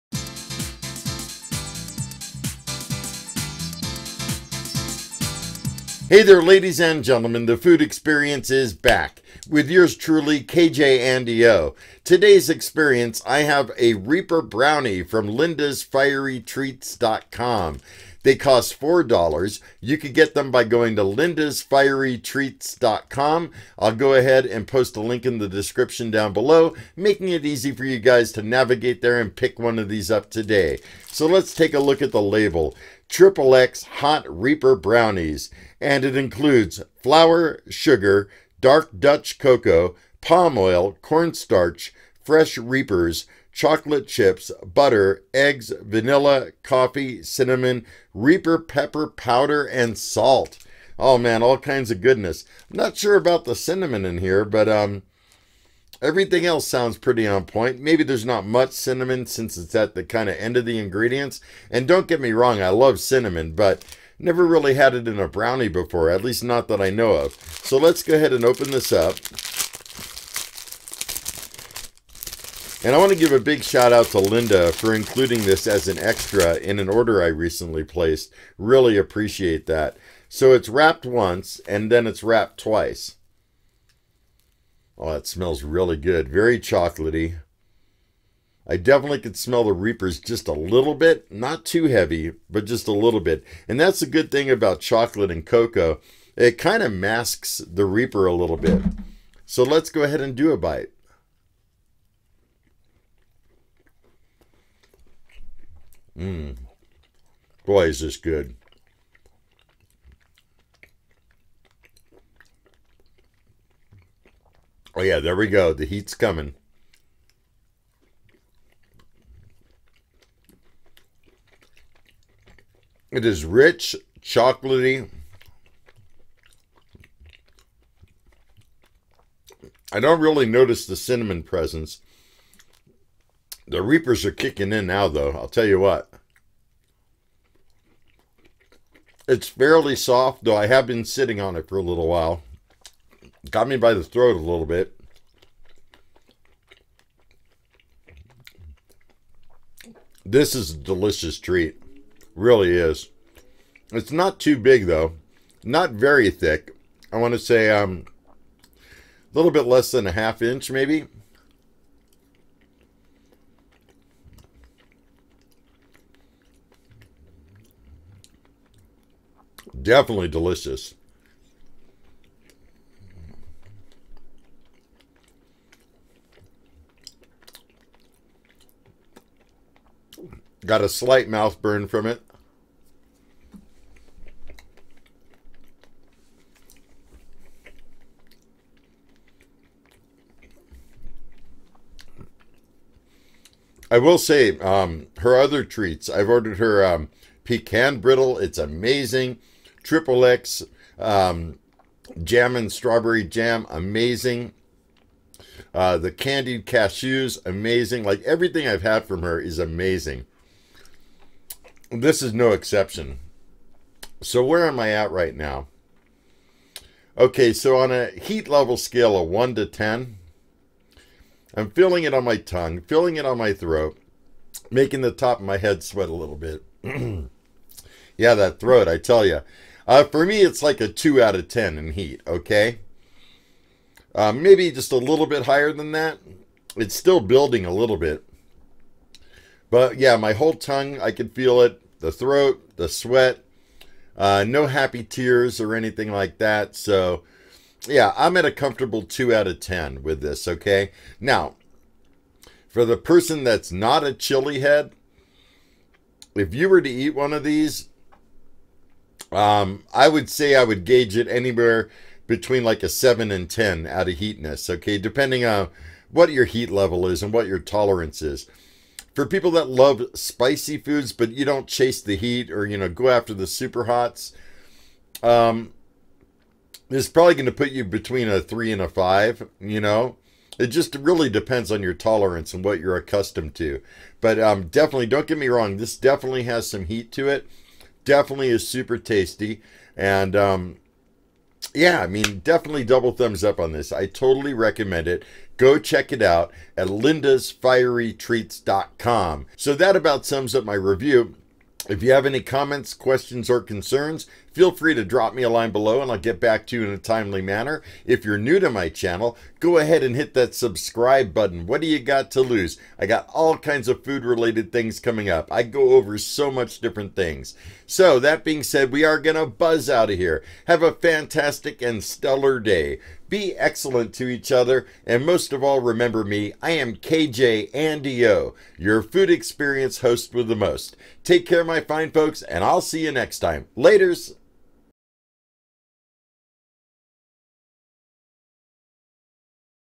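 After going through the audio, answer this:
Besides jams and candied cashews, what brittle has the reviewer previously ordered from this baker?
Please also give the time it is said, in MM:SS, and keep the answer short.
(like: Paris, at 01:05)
Pecan brittle, at 03:17.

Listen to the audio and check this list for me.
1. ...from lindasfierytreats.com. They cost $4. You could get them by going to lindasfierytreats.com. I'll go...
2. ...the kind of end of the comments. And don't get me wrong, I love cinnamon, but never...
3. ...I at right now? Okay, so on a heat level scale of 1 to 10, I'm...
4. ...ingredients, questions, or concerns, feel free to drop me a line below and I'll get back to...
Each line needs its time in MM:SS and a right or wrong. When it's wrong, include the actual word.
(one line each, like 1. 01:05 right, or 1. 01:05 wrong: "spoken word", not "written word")
1. 00:15 right
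2. 00:59 wrong: "ingredients", not "comments"
3. 03:34 right
4. 05:02 wrong: "comments", not "ingredients".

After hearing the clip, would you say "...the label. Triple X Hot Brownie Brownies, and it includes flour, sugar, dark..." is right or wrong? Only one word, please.
wrong.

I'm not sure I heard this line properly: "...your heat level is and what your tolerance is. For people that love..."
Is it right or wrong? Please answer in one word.
right.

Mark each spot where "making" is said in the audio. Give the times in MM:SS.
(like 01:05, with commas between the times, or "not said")
00:26, 03:44.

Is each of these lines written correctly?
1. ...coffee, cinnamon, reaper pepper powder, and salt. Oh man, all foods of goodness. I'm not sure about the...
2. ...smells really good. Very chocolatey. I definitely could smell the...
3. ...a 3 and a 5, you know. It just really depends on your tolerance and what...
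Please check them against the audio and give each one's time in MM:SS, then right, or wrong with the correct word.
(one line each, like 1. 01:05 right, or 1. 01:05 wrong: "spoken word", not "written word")
1. 00:46 wrong: "kinds", not "foods"
2. 01:25 right
3. 04:38 right.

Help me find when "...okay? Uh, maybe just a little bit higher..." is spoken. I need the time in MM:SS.
03:52.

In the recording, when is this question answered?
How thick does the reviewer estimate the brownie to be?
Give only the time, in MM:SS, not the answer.
02:38.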